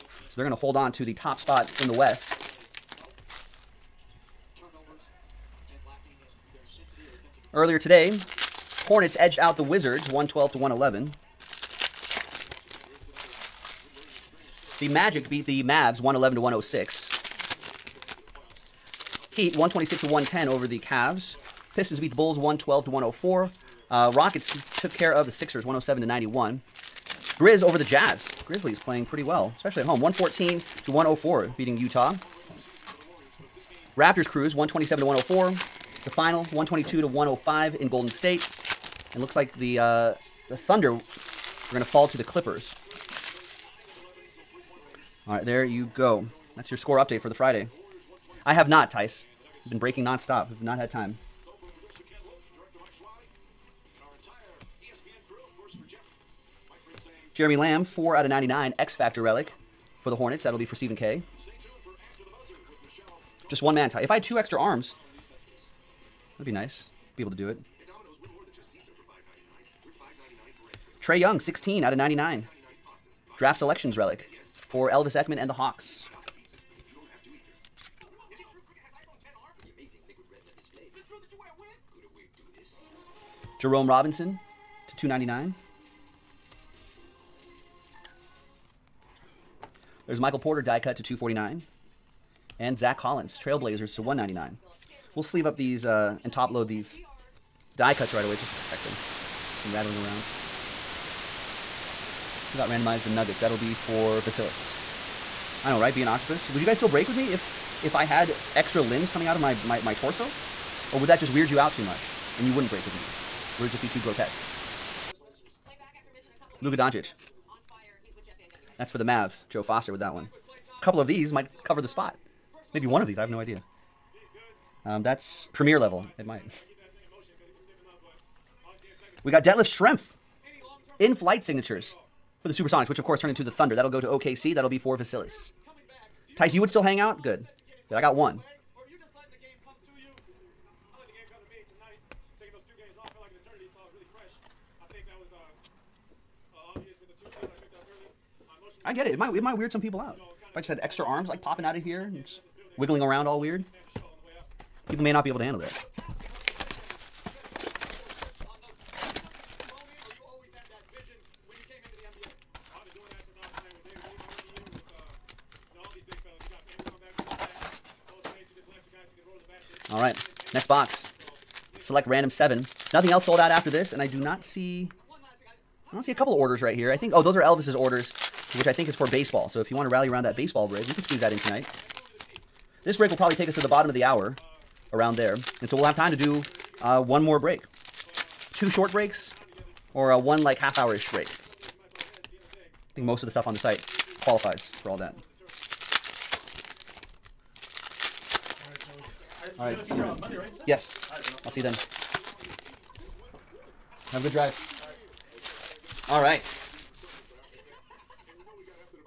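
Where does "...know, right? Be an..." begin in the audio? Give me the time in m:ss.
1:45.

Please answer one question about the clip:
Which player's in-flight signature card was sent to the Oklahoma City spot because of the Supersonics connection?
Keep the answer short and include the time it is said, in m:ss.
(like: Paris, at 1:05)
Detlef Schrempf, at 2:09.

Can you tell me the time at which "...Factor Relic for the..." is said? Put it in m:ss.
0:58.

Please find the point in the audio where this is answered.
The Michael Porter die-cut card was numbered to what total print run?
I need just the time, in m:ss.
1:31.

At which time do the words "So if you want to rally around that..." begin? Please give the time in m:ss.
2:59.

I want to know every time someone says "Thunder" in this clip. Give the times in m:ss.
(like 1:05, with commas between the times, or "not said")
0:40, 2:13.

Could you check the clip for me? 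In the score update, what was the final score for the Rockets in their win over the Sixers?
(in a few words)
107 to 91.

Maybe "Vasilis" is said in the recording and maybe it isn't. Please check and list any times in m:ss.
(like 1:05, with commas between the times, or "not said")
1:44, 2:14.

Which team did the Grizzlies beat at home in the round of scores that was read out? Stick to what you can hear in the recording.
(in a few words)
the Jazz.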